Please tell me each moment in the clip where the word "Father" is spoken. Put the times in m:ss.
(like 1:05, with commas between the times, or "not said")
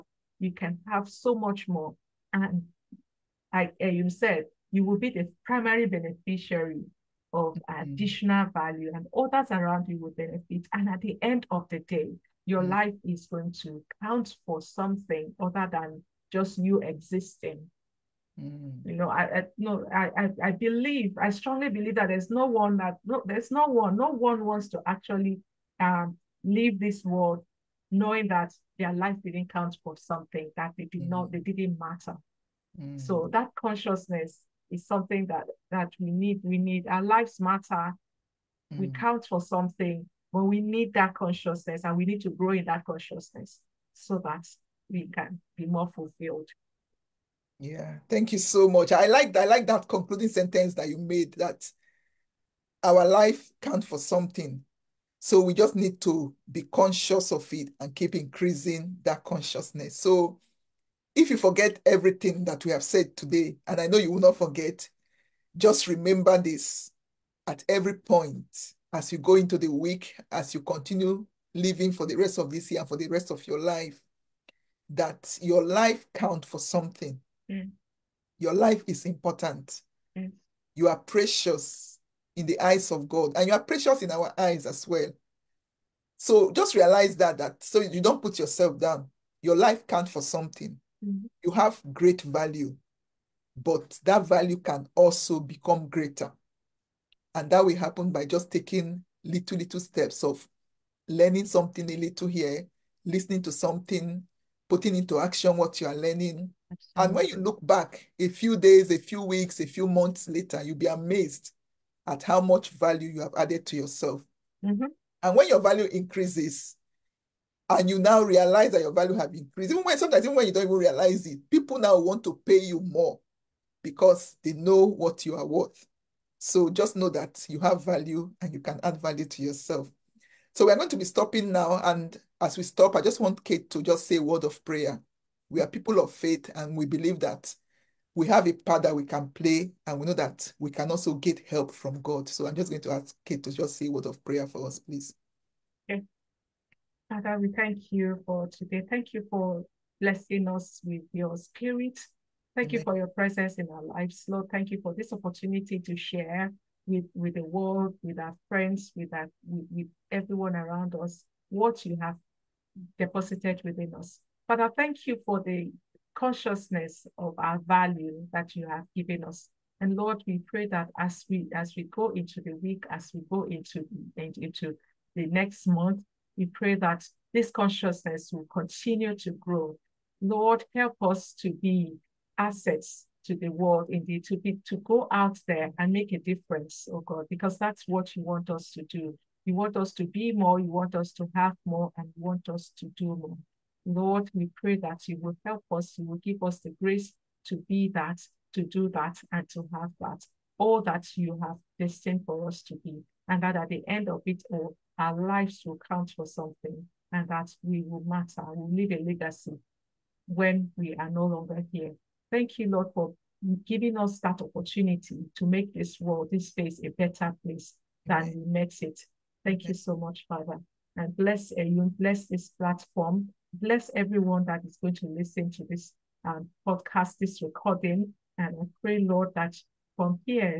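2:27, 2:44, 3:40.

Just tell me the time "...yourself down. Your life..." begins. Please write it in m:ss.
1:28.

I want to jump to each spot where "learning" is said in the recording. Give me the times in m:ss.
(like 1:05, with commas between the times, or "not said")
1:41, 1:45.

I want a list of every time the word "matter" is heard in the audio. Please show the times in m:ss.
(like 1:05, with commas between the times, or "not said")
0:31, 0:37, 3:28.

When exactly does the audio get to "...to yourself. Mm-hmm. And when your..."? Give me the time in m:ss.
1:53.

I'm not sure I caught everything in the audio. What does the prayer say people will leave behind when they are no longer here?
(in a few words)
A legacy.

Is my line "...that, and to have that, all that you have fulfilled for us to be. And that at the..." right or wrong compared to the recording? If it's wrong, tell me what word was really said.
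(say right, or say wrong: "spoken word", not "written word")
wrong: "destined", not "fulfilled".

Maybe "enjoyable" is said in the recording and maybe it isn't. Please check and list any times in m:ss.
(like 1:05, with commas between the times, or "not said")
not said.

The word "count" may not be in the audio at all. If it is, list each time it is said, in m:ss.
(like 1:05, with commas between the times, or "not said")
0:14, 0:29, 0:38, 0:53, 1:16, 1:29, 3:25.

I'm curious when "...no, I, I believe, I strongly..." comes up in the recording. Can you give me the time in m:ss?
0:19.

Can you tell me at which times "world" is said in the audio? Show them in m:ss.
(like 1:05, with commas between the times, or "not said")
0:27, 2:37, 3:03, 3:36.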